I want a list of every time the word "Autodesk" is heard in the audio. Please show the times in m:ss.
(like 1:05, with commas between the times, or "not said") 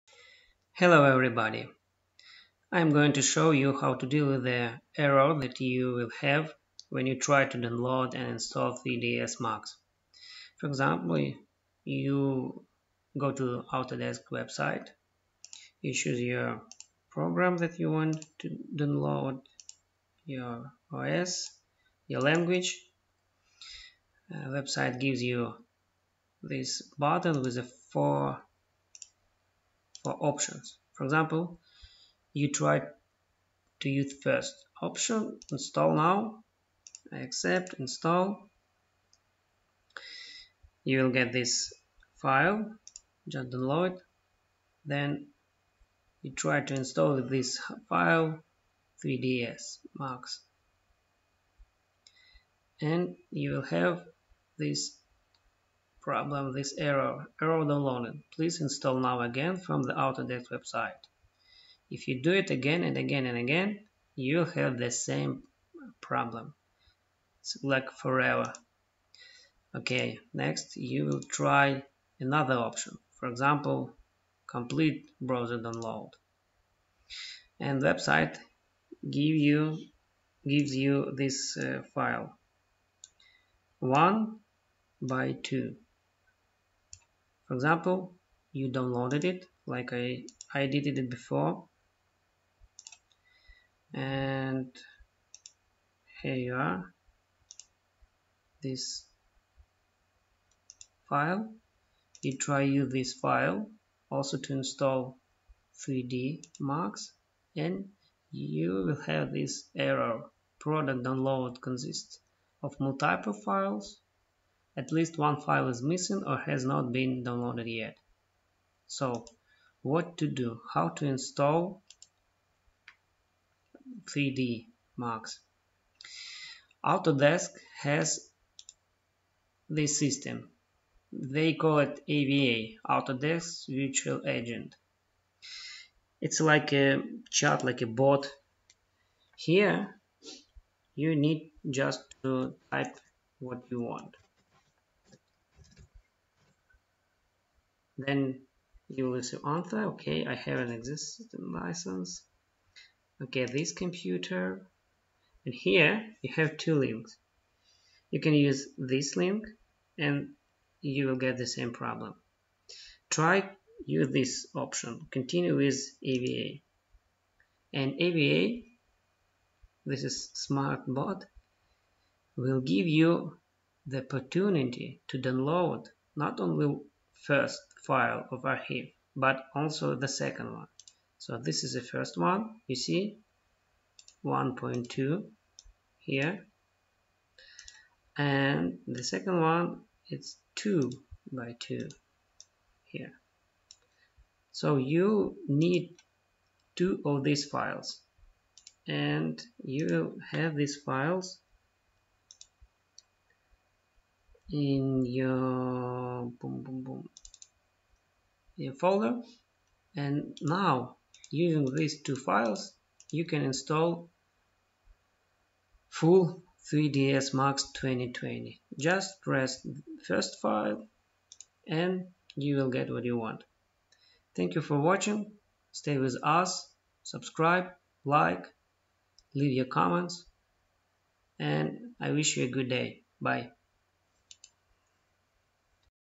0:13, 0:59, 2:06, 2:12.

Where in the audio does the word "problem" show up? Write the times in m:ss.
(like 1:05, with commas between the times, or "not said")
0:56, 1:06, 2:41.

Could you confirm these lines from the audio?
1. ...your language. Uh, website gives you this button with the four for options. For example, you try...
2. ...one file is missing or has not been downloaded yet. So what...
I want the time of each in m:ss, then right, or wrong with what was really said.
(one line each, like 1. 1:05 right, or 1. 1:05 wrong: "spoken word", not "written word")
1. 0:22 right
2. 1:55 right.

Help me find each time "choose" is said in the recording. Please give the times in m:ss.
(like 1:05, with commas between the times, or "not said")
0:15.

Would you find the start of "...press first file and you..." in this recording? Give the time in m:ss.
3:39.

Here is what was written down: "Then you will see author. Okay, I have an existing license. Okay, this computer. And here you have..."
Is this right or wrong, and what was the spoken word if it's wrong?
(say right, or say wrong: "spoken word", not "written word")
right.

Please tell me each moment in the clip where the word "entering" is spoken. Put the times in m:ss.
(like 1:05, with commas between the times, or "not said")
not said.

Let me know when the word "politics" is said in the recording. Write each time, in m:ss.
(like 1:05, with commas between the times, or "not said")
not said.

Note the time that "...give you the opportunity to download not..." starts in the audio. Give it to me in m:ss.
2:52.